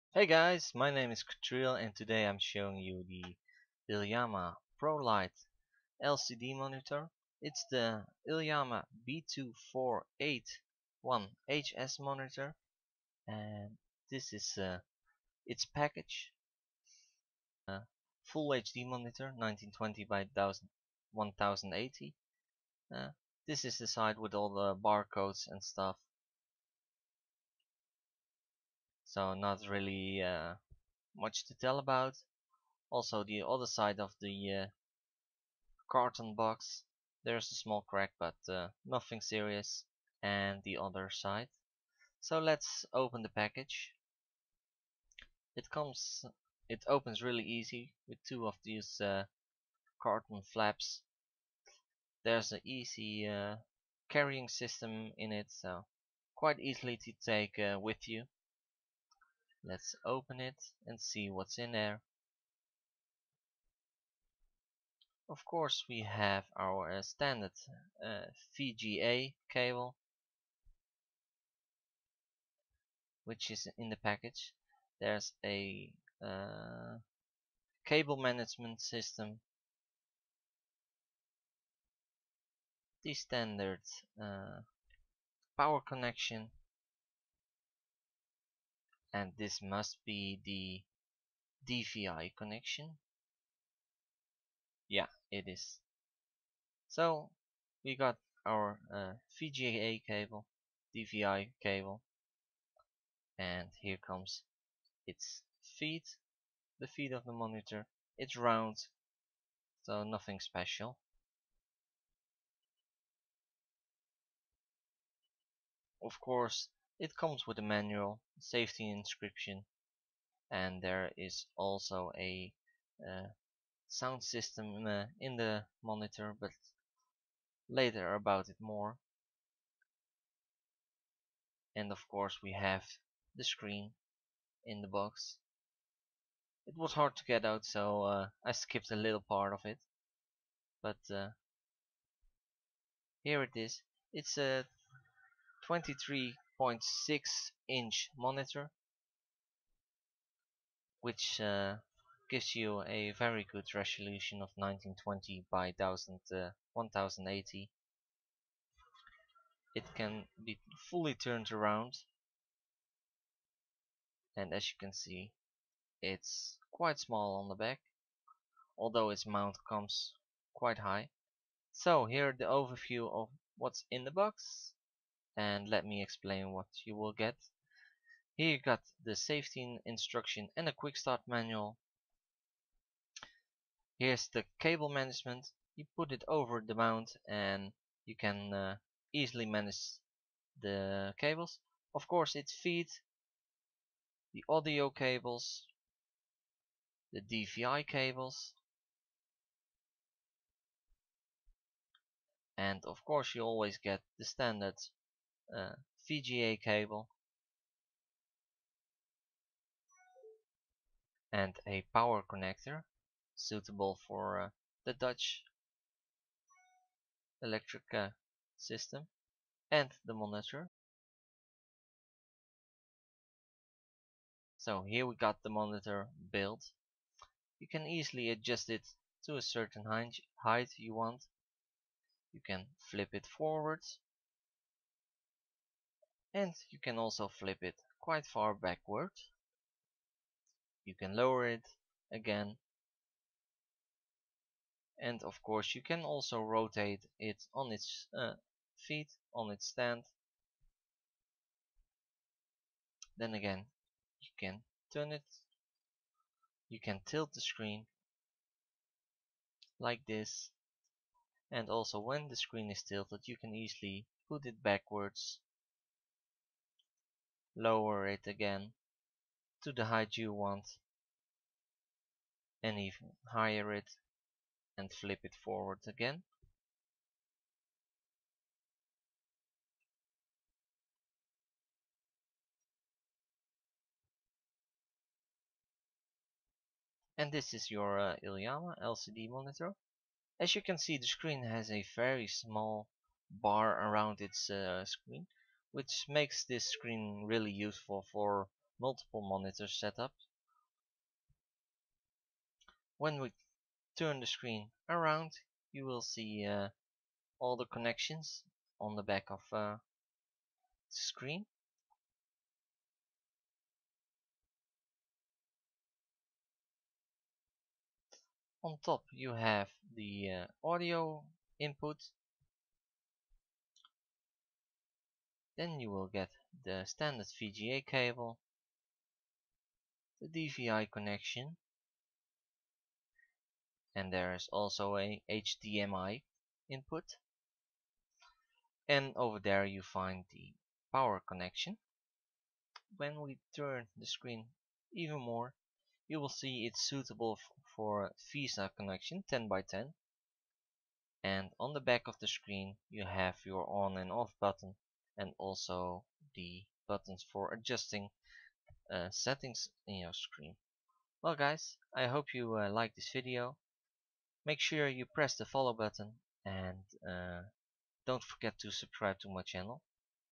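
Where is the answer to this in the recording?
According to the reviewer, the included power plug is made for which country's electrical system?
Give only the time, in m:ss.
3:34.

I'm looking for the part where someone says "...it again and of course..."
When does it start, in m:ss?
4:01.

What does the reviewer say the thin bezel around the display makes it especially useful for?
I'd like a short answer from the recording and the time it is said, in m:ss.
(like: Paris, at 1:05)
multiple monitor setups, at 4:58.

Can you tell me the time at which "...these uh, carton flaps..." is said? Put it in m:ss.
0:48.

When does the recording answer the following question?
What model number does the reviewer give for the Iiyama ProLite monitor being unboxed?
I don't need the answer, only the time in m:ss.
0:09.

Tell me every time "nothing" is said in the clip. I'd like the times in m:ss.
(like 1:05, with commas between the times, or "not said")
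0:38, 1:50.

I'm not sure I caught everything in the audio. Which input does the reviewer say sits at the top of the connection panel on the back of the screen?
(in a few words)
audio input.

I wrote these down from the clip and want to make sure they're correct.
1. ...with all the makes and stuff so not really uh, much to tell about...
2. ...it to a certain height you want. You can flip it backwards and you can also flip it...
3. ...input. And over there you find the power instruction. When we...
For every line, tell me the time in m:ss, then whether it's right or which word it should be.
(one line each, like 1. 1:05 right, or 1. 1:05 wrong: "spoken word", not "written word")
1. 0:24 wrong: "barcodes", not "makes"
2. 3:48 wrong: "forwards", not "backwards"
3. 5:36 wrong: "connection", not "instruction".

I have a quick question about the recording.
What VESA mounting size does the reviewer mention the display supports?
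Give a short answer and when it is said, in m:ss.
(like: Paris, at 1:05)
10 by 10, at 5:49.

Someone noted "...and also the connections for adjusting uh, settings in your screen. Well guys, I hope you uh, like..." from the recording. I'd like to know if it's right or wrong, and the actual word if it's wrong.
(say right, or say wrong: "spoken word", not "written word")
wrong: "buttons", not "connections".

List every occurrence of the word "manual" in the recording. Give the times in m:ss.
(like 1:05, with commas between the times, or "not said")
1:57, 3:01.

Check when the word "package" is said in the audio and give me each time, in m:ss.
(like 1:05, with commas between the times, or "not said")
0:15, 0:43, 1:13.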